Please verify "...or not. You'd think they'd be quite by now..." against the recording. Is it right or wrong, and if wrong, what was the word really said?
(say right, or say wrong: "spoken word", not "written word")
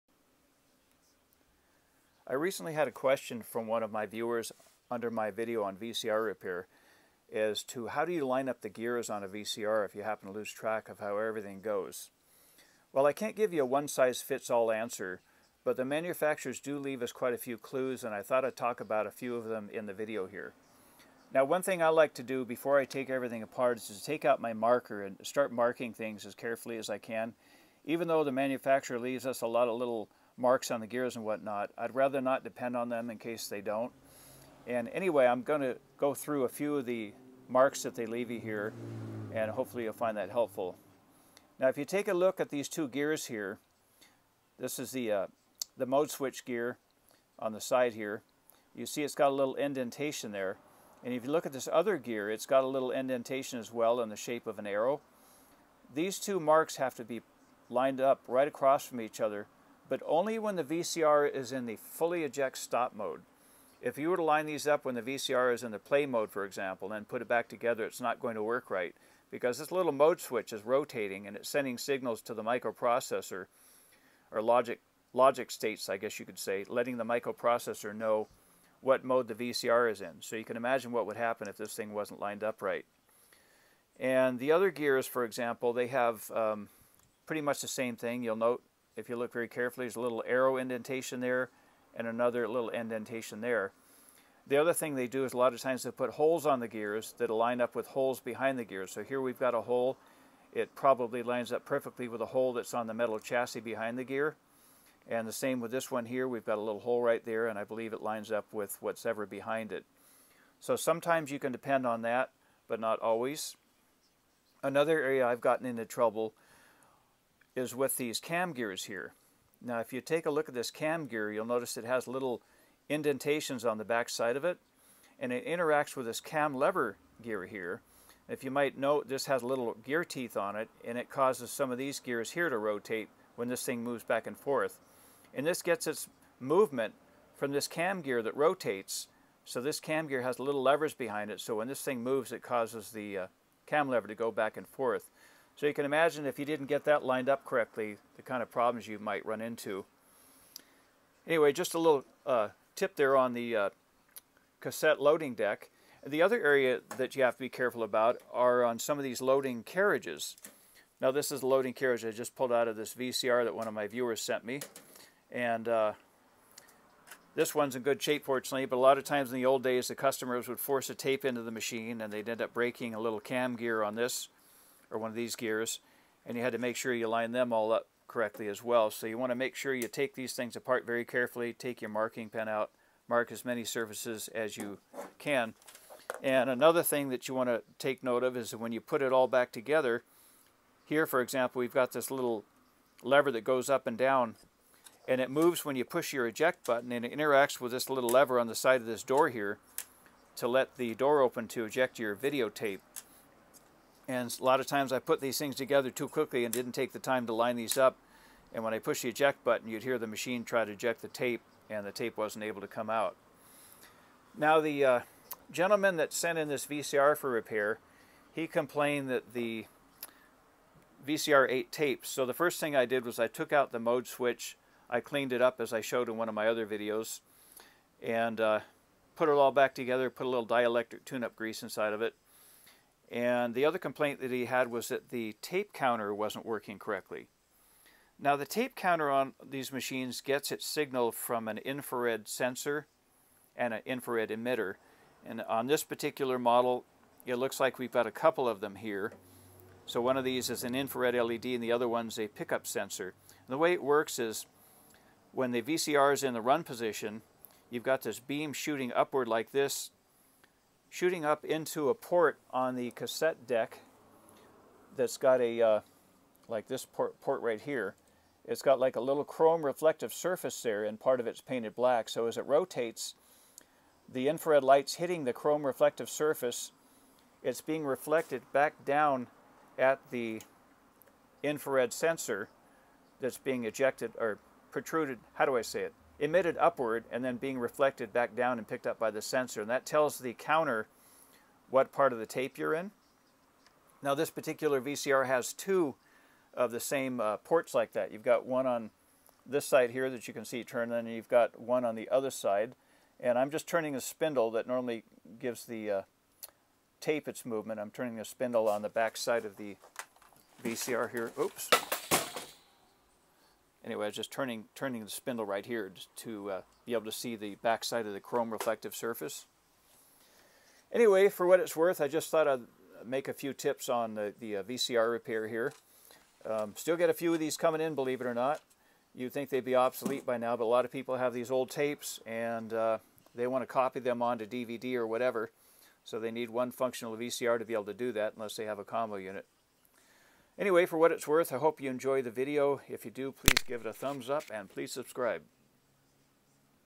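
wrong: "obsolete", not "quite".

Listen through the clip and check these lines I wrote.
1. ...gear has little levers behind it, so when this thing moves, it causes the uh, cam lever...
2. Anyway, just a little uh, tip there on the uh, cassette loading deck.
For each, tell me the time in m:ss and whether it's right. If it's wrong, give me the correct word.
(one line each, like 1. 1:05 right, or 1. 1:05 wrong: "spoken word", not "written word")
1. 2:20 right
2. 2:31 right.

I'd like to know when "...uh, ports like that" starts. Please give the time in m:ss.
4:57.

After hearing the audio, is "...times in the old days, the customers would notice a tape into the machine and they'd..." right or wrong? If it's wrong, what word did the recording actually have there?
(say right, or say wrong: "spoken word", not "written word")
wrong: "force", not "notice".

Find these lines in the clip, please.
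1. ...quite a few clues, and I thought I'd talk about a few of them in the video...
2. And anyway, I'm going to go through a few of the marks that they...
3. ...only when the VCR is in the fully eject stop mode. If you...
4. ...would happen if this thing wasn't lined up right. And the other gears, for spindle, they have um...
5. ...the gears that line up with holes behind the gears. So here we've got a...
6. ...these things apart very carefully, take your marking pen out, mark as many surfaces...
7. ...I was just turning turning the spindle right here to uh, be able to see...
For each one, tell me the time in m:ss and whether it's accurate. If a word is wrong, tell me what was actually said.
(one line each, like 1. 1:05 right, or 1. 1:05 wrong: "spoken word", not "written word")
1. 0:17 right
2. 0:34 right
3. 1:00 right
4. 1:21 wrong: "example", not "spindle"
5. 1:36 right
6. 3:00 right
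7. 5:14 right.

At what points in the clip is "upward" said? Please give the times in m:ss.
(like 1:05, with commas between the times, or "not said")
4:18, 4:46.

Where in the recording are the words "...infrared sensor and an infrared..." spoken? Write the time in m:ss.
4:01.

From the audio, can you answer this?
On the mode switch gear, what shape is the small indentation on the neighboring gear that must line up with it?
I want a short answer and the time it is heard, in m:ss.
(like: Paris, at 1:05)
an arrow, at 0:54.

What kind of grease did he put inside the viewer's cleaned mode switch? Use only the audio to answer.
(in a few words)
dielectric tune-up grease.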